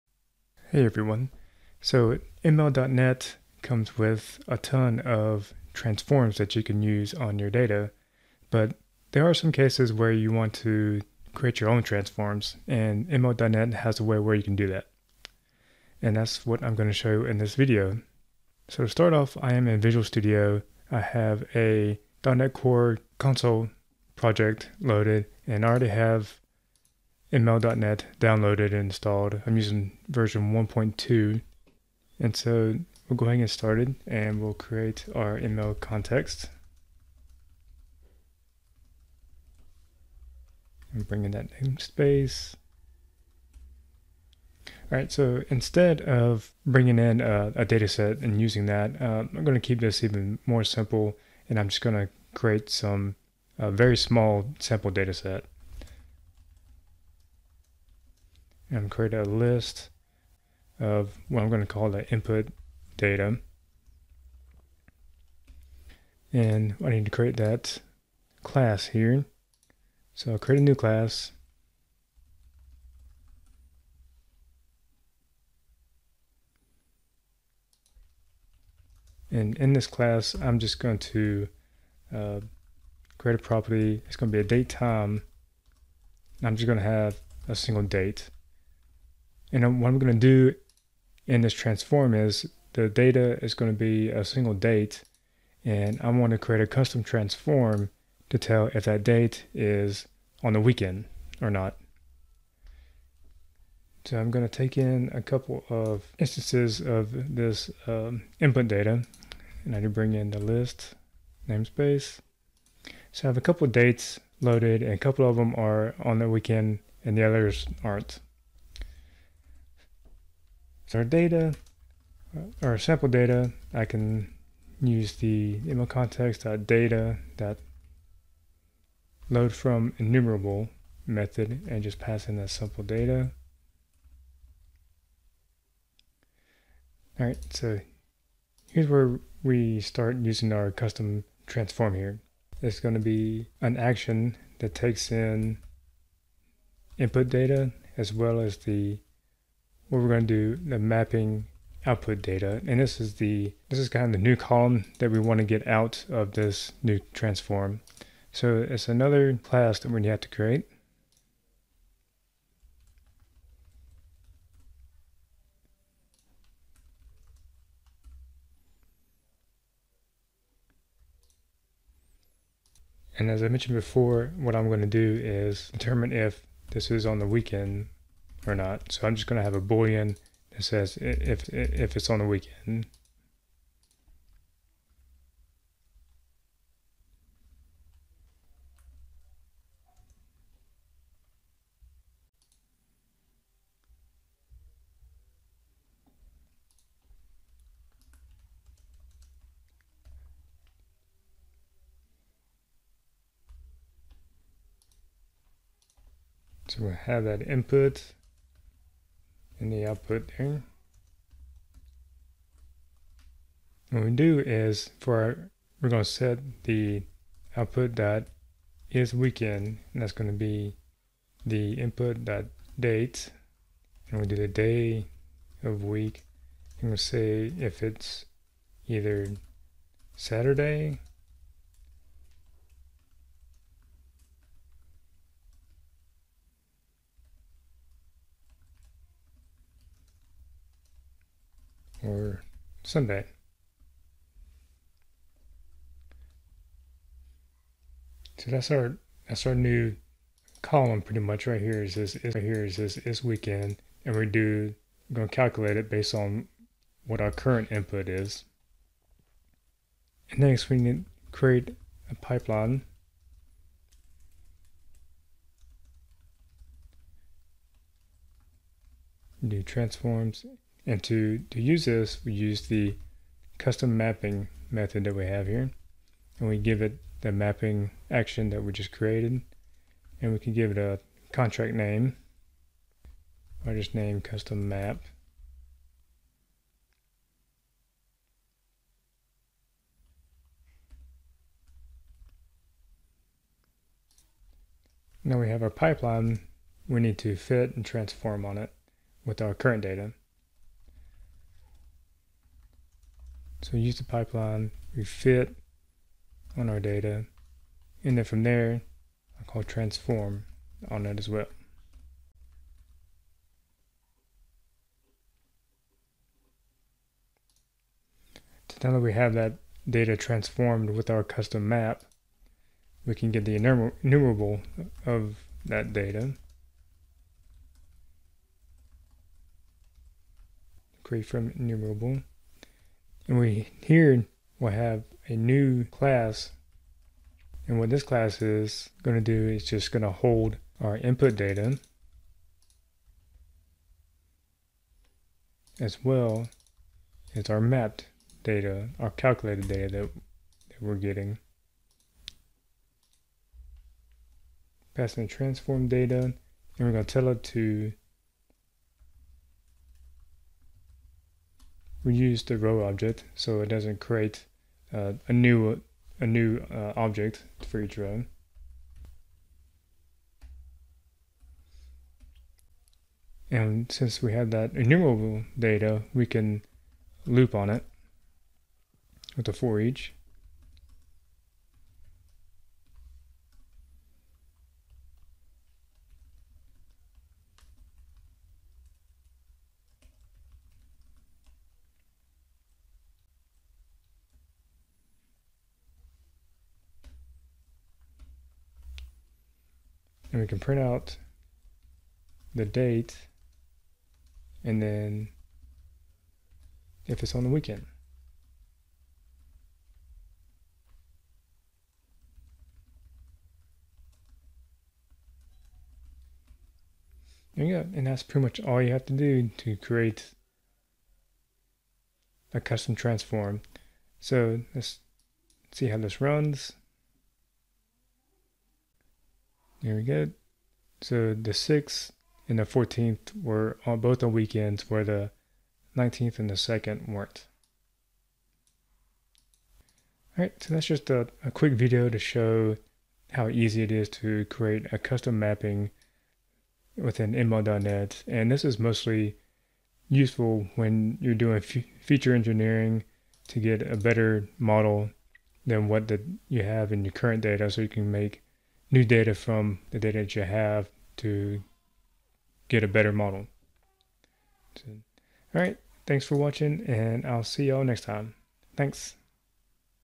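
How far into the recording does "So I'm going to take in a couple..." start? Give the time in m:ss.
1:44.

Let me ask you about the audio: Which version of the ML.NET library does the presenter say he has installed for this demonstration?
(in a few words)
1.2.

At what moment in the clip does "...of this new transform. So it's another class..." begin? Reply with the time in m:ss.
2:36.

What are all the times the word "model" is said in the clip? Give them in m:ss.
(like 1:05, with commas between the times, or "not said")
7:34, 7:43.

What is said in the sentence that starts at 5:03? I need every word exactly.
So we use the pipeline, we fit on our data, and then from there, I call transform on that as well.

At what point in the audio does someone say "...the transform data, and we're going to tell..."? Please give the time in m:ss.
5:55.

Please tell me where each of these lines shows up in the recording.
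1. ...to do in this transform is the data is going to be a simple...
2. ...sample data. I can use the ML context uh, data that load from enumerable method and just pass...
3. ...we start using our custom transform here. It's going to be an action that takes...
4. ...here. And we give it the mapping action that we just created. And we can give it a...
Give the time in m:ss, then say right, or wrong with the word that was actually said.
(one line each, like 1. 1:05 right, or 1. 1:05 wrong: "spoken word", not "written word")
1. 1:30 wrong: "single", not "simple"
2. 2:02 right
3. 2:19 right
4. 4:35 right.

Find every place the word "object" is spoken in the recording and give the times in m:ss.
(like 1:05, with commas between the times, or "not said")
6:02, 6:06.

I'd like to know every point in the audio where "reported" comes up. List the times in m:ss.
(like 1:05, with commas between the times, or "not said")
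not said.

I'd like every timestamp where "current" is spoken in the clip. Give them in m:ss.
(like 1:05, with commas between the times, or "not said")
4:17, 4:59, 7:37.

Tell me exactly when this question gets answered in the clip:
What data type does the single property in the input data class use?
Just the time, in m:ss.
1:24.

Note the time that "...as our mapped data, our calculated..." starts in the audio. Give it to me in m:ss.
5:47.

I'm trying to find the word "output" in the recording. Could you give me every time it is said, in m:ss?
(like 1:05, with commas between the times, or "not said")
2:31, 3:29, 3:37.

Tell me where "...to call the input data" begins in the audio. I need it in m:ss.
1:01.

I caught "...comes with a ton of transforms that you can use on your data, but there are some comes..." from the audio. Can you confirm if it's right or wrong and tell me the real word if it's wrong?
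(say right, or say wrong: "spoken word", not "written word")
wrong: "cases", not "comes".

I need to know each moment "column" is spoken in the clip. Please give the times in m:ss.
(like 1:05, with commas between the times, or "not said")
2:34, 4:10.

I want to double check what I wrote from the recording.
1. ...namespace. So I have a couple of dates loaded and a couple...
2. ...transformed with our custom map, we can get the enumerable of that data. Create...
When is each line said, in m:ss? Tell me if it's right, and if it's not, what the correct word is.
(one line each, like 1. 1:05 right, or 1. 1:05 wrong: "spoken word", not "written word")
1. 1:51 right
2. 5:20 right.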